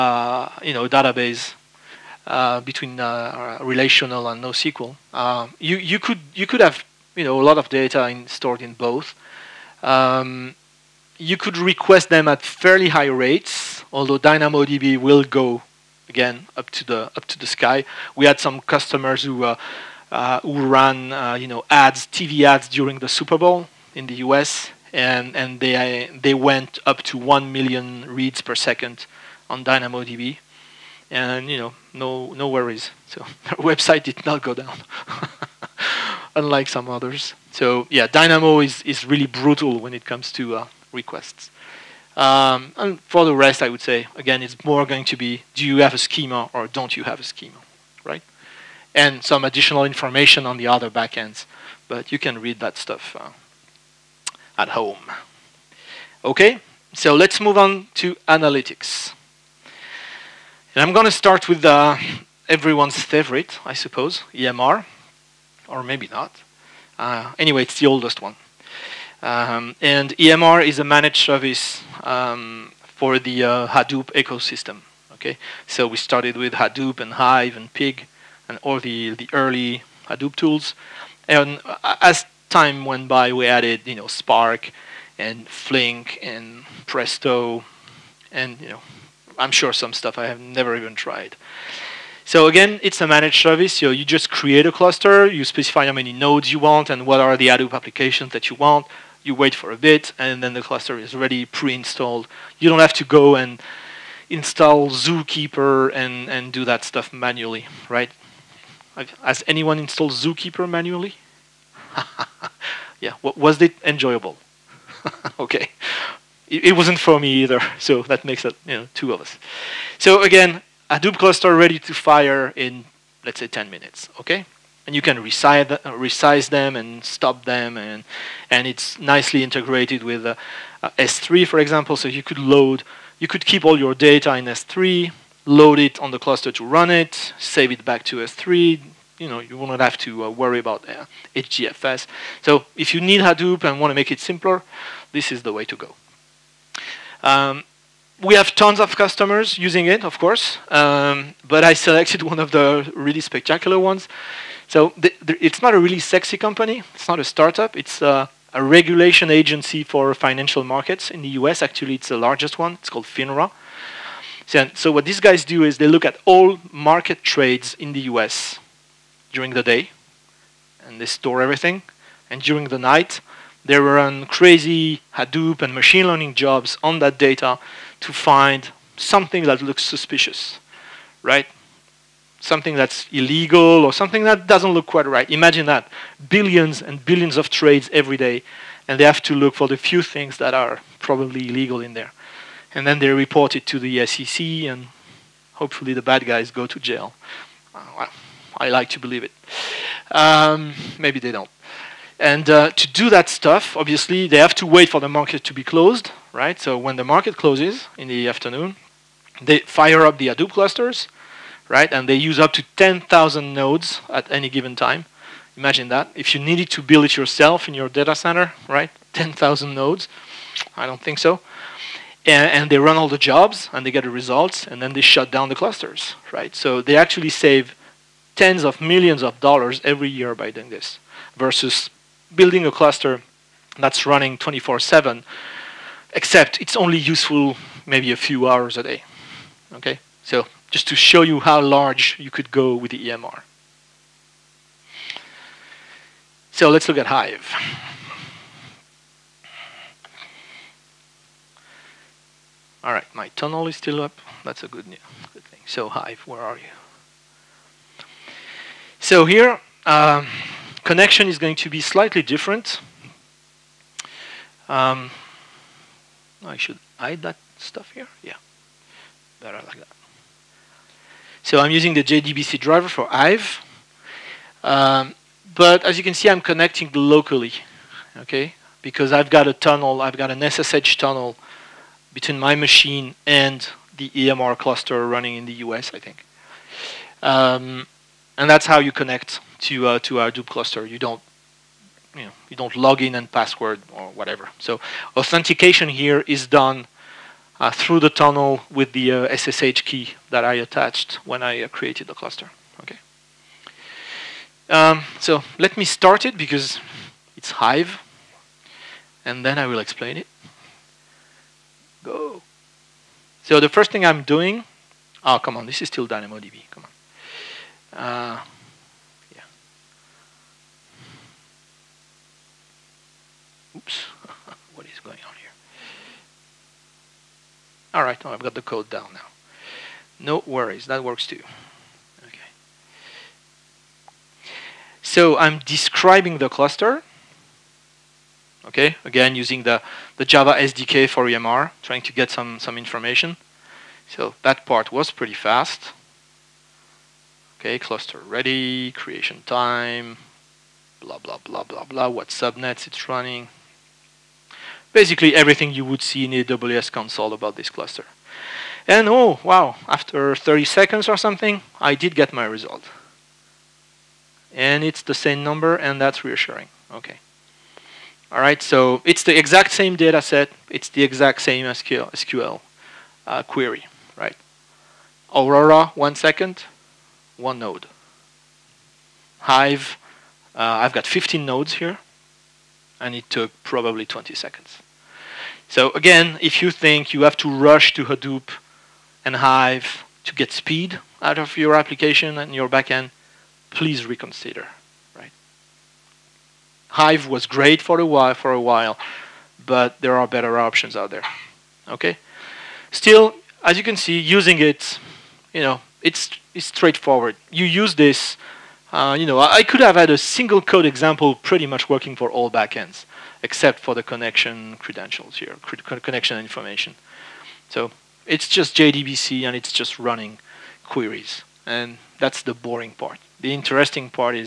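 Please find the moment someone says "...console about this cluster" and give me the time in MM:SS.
05:56.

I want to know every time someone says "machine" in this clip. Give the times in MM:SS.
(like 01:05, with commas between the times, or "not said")
02:55, 04:42.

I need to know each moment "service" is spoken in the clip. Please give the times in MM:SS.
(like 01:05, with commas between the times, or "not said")
01:11, 01:33.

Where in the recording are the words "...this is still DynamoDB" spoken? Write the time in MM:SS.
05:15.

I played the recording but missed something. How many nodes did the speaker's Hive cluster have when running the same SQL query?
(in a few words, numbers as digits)
15.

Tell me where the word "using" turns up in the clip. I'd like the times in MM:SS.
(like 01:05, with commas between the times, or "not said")
02:29, 04:31, 05:39, 06:44.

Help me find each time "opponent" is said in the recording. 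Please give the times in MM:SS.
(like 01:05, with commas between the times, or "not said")
not said.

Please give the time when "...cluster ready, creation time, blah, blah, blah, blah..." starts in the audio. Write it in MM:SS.
05:47.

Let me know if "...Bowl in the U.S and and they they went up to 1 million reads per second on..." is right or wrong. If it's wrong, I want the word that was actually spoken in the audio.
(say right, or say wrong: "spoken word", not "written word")
right.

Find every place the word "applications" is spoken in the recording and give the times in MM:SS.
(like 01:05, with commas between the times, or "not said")
01:37, 06:31.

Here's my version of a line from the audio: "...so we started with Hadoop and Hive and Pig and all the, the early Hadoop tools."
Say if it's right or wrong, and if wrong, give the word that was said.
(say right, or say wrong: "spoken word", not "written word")
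right.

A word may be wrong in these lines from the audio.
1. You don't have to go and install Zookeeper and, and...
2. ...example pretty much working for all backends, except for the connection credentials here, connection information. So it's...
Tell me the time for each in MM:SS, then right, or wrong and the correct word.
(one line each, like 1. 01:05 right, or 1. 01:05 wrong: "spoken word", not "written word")
1. 01:42 right
2. 06:50 right.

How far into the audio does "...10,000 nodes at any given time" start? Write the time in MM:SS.
03:32.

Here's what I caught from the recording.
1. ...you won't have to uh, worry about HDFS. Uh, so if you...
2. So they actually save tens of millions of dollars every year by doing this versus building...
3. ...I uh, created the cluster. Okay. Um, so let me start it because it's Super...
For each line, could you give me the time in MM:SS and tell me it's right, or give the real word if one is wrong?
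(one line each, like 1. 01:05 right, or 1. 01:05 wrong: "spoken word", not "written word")
1. 02:19 right
2. 03:46 right
3. 05:01 wrong: "Hive", not "Super".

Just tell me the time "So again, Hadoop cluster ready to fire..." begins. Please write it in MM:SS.
01:59.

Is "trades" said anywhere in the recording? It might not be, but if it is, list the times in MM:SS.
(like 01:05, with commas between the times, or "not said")
02:47, 03:07.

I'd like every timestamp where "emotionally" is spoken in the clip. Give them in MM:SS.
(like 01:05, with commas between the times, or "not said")
not said.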